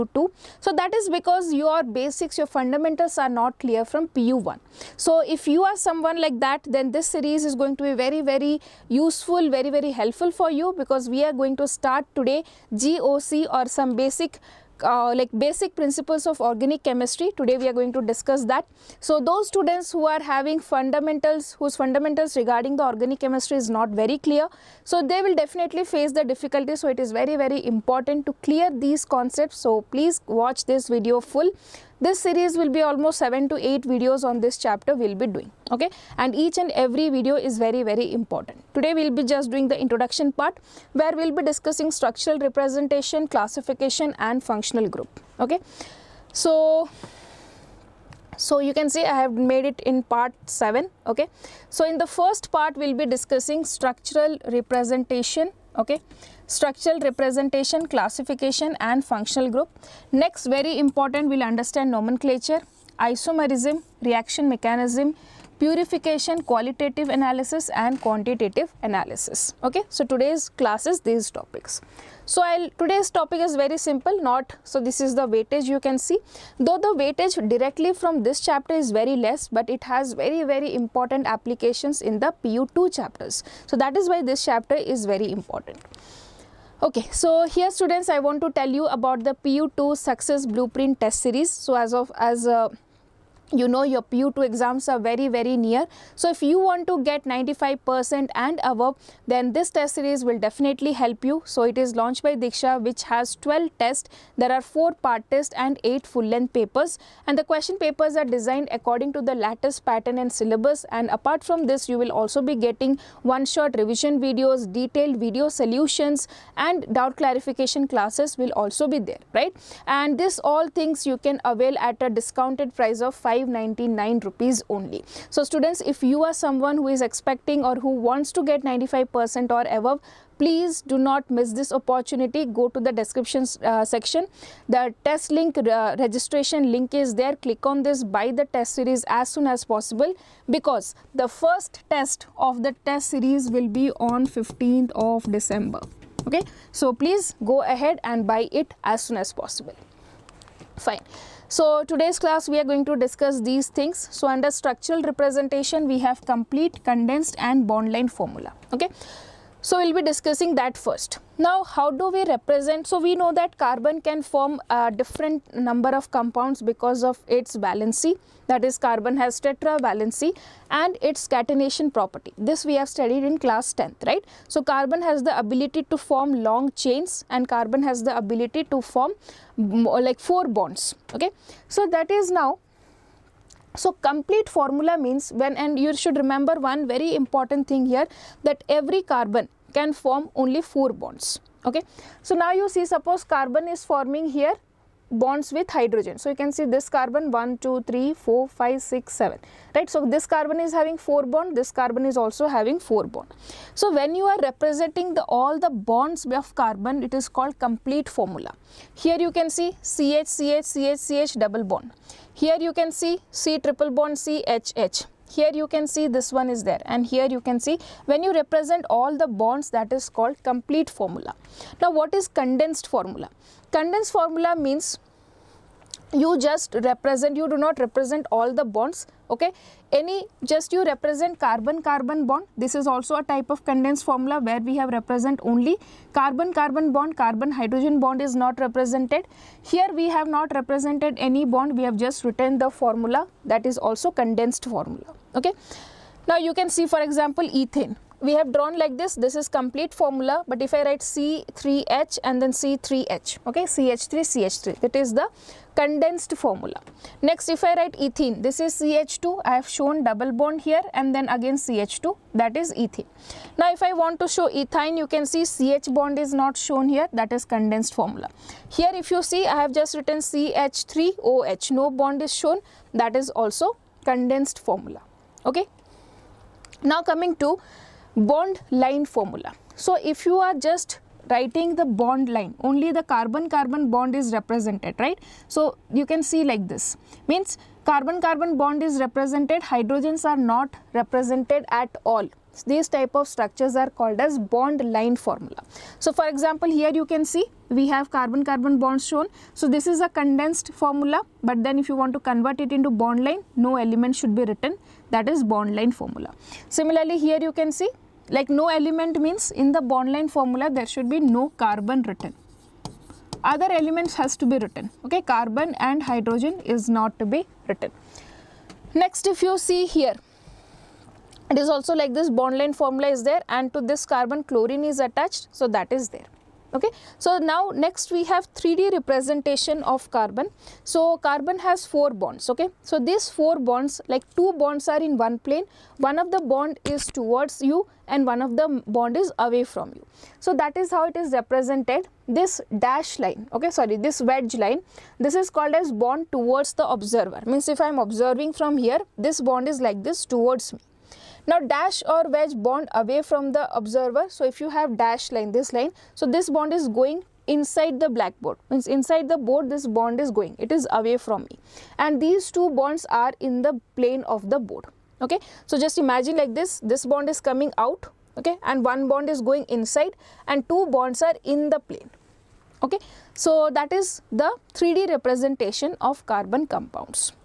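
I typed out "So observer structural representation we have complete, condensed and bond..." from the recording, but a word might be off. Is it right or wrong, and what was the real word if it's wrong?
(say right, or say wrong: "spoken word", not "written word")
wrong: "under", not "observer".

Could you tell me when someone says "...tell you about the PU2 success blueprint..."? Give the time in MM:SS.
01:28.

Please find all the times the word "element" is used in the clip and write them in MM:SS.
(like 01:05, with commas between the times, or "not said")
05:03, 05:08, 05:13.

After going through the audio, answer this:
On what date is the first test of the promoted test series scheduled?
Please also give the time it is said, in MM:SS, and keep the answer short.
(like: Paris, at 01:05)
15th of December, at 02:24.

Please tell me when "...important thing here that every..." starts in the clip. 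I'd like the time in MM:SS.
03:07.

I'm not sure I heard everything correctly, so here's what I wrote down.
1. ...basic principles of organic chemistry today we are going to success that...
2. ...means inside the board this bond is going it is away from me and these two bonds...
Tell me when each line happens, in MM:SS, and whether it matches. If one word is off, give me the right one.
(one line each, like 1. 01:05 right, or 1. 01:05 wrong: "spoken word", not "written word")
1. 00:15 wrong: "discuss", not "success"
2. 05:58 right.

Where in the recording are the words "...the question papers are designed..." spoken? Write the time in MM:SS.
01:47.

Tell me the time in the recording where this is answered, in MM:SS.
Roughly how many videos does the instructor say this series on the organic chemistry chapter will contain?
00:33.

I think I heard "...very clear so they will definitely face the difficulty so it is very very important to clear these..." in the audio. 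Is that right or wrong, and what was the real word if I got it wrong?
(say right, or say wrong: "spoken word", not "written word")
right.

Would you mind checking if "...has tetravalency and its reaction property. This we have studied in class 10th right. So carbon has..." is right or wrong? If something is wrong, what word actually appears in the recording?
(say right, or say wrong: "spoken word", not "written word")
wrong: "catenation", not "reaction".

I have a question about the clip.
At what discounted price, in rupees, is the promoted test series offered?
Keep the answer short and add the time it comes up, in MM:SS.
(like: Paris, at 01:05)
599, at 02:03.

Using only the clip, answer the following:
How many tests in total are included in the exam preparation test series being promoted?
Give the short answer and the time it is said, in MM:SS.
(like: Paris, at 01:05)
12, at 01:43.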